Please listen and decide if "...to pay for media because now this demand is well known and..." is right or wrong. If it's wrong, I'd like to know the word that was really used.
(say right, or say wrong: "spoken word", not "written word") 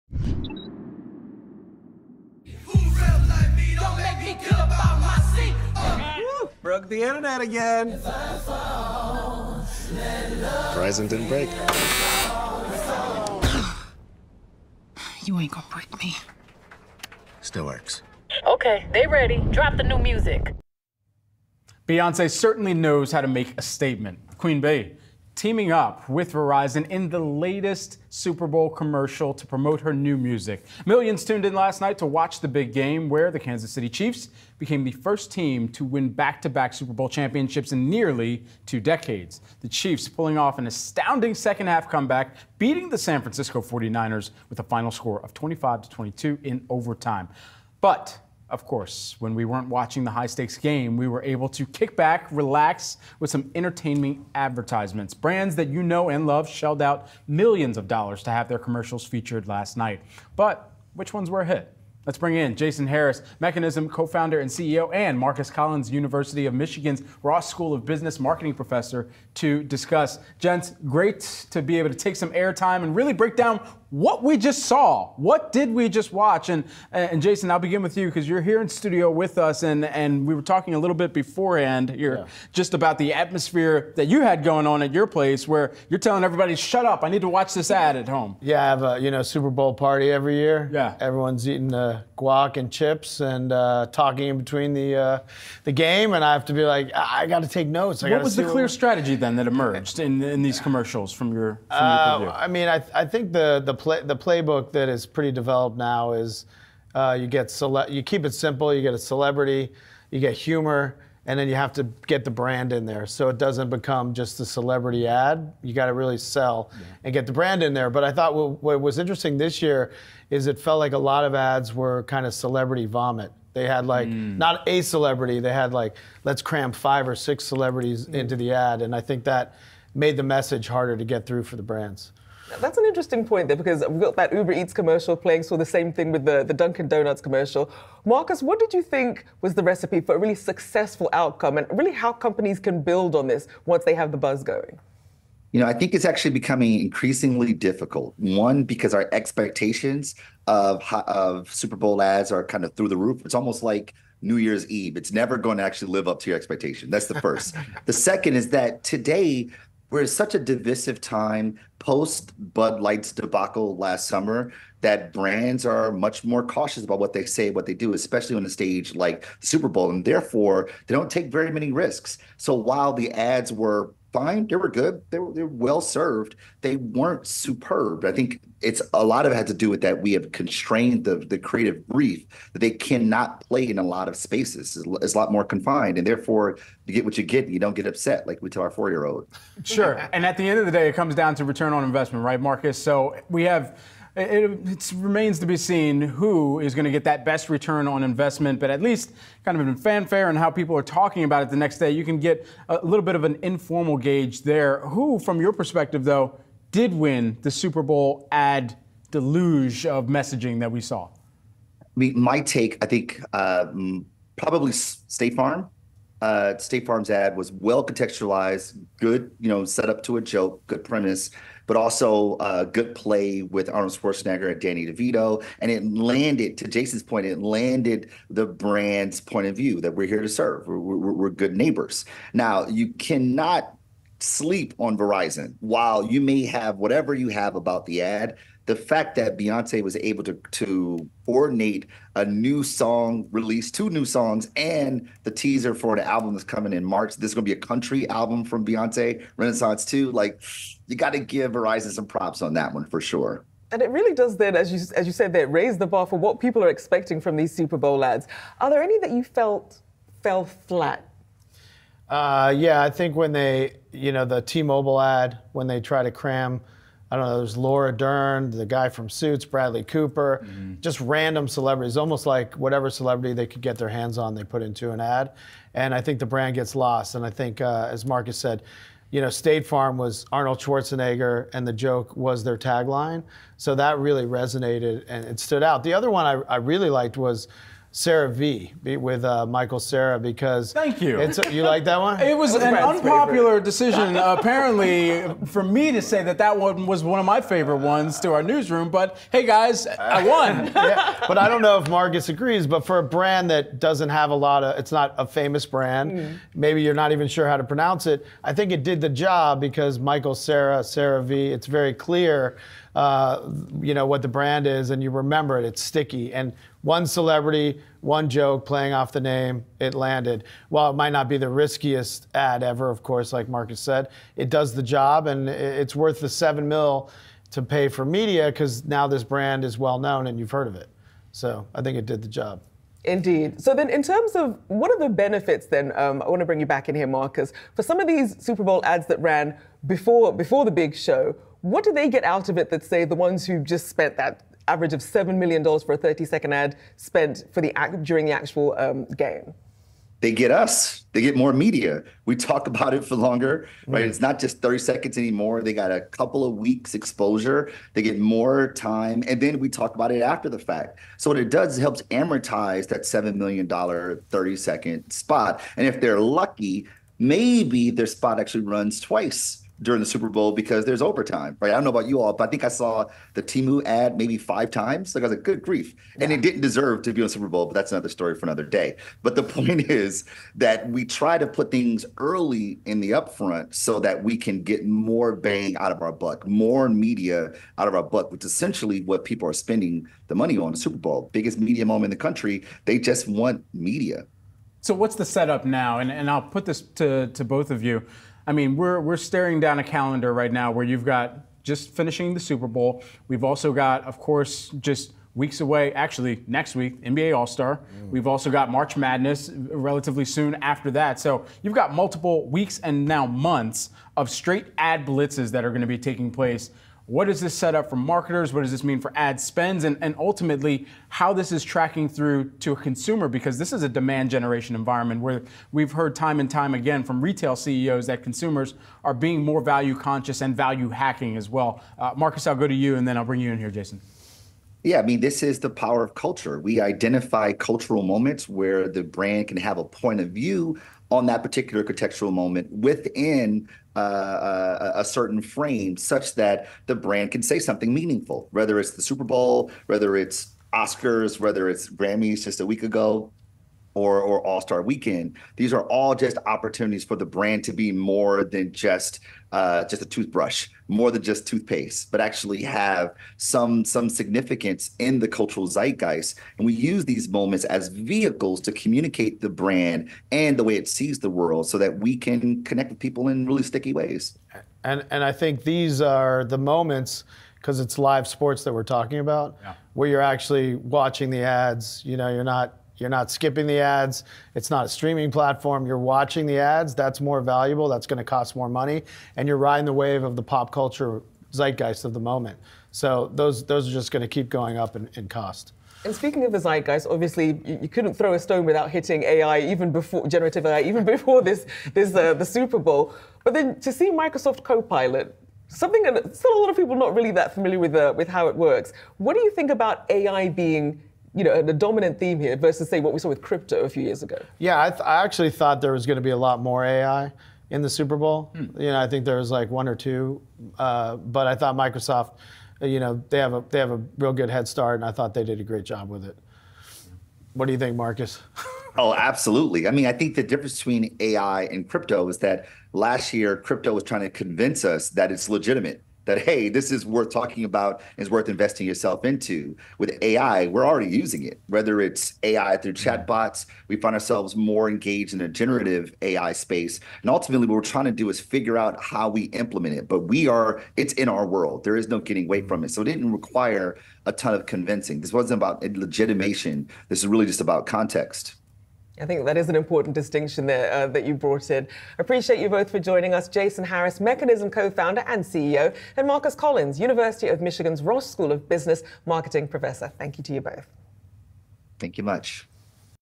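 wrong: "brand", not "demand".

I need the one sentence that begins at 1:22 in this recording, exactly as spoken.
just about the atmosphere that you had going on at your place, where you're telling everybody, "Shut up!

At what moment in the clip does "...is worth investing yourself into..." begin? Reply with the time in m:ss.
8:58.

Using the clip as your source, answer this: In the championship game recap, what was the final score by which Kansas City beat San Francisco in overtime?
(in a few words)
25 to 22.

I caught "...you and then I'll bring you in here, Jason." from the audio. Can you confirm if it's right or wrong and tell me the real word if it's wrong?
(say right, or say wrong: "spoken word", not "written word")
right.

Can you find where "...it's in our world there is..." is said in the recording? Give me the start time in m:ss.
9:10.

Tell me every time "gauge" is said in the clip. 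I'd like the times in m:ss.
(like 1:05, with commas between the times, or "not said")
3:23.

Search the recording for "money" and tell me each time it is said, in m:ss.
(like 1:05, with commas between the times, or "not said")
6:30, 8:08.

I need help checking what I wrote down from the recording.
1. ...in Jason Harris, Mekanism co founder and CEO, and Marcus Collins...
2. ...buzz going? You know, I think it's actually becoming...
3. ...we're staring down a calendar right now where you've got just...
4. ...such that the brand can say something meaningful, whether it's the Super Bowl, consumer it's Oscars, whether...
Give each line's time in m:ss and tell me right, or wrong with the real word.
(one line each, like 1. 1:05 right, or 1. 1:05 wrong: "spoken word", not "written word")
1. 1:02 right
2. 2:24 right
3. 6:38 right
4. 7:25 wrong: "whether", not "consumer".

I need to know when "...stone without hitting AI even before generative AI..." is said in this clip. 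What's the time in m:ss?
8:18.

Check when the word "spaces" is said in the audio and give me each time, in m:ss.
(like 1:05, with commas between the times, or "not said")
3:04, 9:06.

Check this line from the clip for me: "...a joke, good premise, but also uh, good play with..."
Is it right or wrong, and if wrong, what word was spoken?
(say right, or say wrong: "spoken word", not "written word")
right.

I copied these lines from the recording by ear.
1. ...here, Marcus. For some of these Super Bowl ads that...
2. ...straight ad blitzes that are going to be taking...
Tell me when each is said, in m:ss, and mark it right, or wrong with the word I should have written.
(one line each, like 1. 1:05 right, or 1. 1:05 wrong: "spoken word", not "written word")
1. 5:36 right
2. 6:54 right.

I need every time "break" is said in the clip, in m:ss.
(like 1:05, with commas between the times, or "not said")
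0:11, 0:15, 1:13.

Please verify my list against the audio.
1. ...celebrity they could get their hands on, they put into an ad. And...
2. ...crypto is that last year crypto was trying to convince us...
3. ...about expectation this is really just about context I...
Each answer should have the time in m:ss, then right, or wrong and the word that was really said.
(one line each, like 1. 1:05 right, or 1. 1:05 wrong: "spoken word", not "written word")
1. 4:32 right
2. 8:51 right
3. 9:15 wrong: "legitimation", not "expectation".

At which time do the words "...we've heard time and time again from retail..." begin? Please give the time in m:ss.
7:05.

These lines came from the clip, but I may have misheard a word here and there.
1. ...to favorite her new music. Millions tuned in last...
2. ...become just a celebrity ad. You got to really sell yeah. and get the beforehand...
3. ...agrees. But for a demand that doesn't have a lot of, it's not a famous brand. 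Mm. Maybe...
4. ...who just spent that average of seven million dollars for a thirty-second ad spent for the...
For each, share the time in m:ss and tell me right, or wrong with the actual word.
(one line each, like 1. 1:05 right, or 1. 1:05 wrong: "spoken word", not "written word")
1. 0:29 wrong: "promote", not "favorite"
2. 1:53 wrong: "brand", not "beforehand"
3. 5:02 wrong: "brand", not "demand"
4. 5:43 right.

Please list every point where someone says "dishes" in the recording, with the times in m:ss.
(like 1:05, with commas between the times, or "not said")
not said.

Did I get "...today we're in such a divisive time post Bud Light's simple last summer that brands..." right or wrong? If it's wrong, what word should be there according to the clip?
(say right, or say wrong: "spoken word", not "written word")
wrong: "debacle", not "simple".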